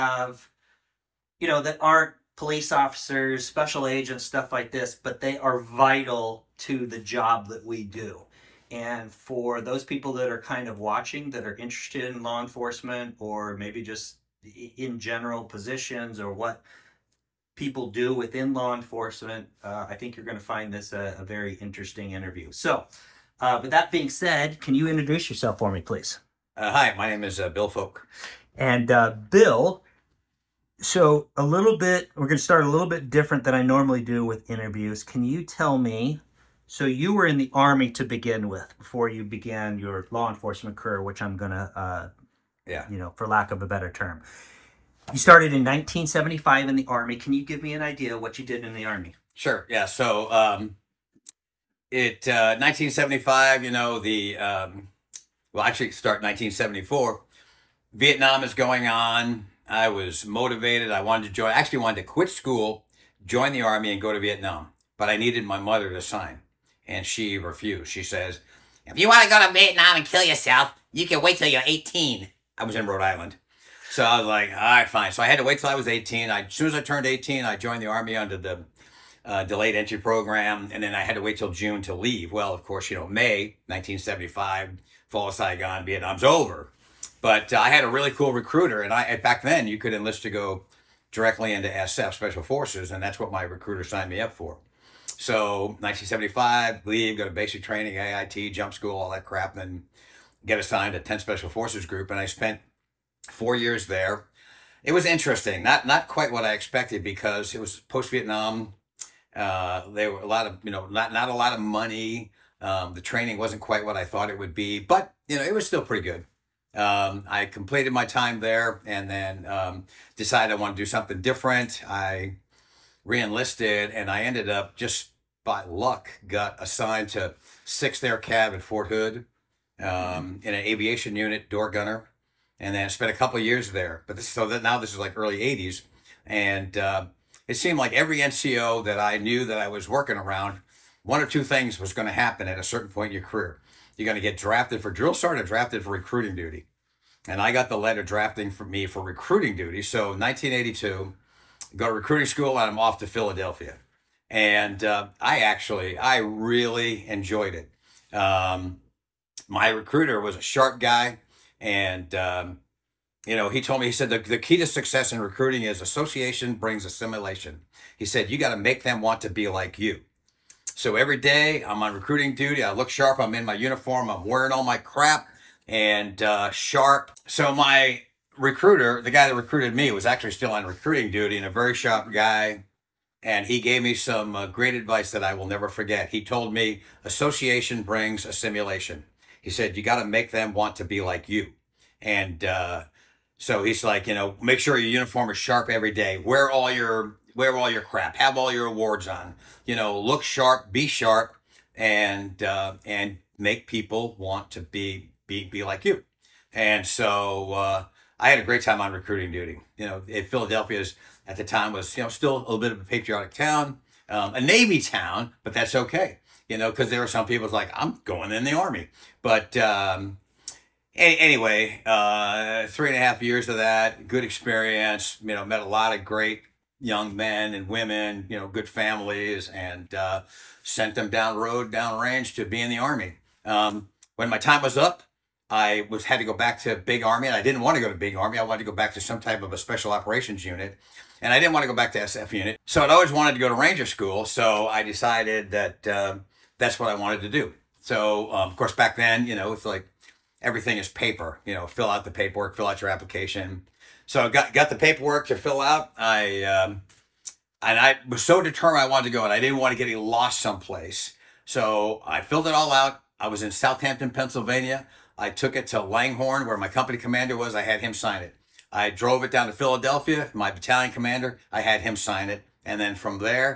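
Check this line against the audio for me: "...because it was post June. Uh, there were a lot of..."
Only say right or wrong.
wrong.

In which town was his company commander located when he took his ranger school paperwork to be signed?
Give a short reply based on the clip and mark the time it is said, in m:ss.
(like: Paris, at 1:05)
Langhorne, at 4:25.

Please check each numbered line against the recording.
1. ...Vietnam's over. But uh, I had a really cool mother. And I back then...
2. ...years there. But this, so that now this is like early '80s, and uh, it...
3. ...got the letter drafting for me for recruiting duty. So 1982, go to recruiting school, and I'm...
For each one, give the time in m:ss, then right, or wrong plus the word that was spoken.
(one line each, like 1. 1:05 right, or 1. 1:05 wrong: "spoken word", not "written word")
1. 1:25 wrong: "recruiter", not "mother"
2. 2:13 right
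3. 2:27 right.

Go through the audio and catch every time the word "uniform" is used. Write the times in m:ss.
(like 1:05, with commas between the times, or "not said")
2:53, 3:14.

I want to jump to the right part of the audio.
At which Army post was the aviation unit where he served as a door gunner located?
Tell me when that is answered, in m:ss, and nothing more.
2:08.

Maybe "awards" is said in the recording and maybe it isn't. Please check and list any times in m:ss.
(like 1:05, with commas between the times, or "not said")
3:18.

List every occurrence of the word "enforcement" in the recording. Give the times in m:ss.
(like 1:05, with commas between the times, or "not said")
0:12, 0:18, 0:40.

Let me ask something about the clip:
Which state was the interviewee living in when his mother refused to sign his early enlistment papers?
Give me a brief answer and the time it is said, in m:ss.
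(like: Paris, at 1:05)
Rhode Island, at 1:12.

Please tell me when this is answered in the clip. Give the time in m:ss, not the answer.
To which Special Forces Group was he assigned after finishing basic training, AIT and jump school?
1:40.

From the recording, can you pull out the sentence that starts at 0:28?
And uh, Bill, so a little bit, we're going to start a little bit different than I normally do with interviews.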